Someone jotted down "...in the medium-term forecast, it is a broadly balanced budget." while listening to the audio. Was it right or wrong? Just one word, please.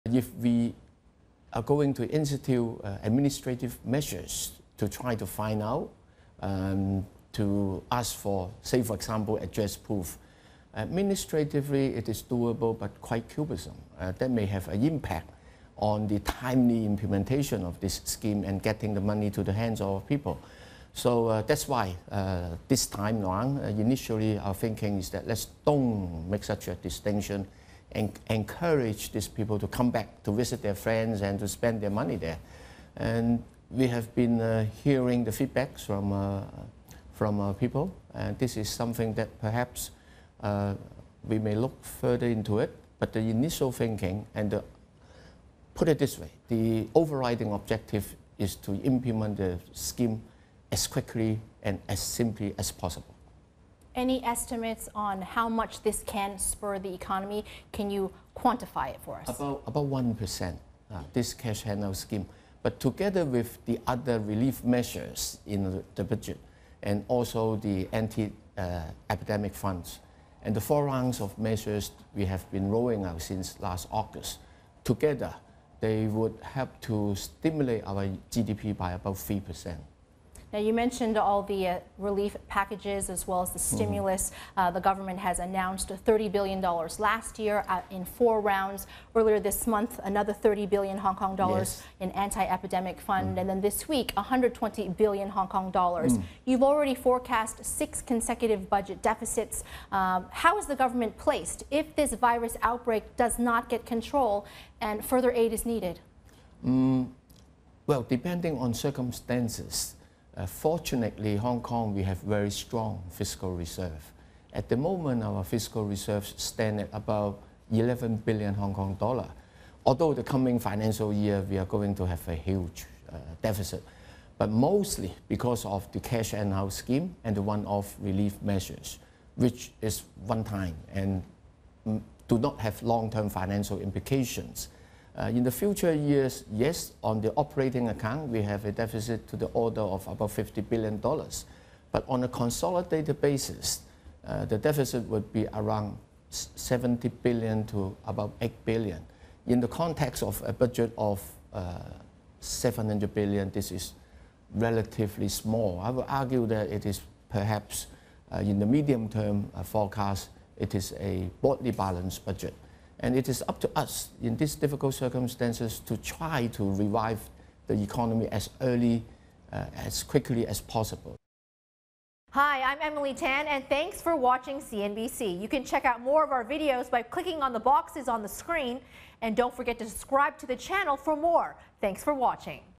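right.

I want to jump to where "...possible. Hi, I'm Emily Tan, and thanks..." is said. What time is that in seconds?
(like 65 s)
170 s.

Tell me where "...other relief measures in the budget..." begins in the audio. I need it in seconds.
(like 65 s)
63 s.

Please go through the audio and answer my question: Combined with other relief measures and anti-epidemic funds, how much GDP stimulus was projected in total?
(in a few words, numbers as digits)
3%.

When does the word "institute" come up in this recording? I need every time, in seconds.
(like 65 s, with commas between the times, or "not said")
2 s.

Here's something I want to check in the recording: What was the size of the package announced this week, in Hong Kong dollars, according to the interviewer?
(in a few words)
120 billion Hong Kong dollars.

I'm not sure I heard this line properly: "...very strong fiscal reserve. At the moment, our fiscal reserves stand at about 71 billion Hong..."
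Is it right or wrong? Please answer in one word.
wrong.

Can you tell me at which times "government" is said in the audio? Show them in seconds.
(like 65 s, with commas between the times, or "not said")
84 s, 100 s.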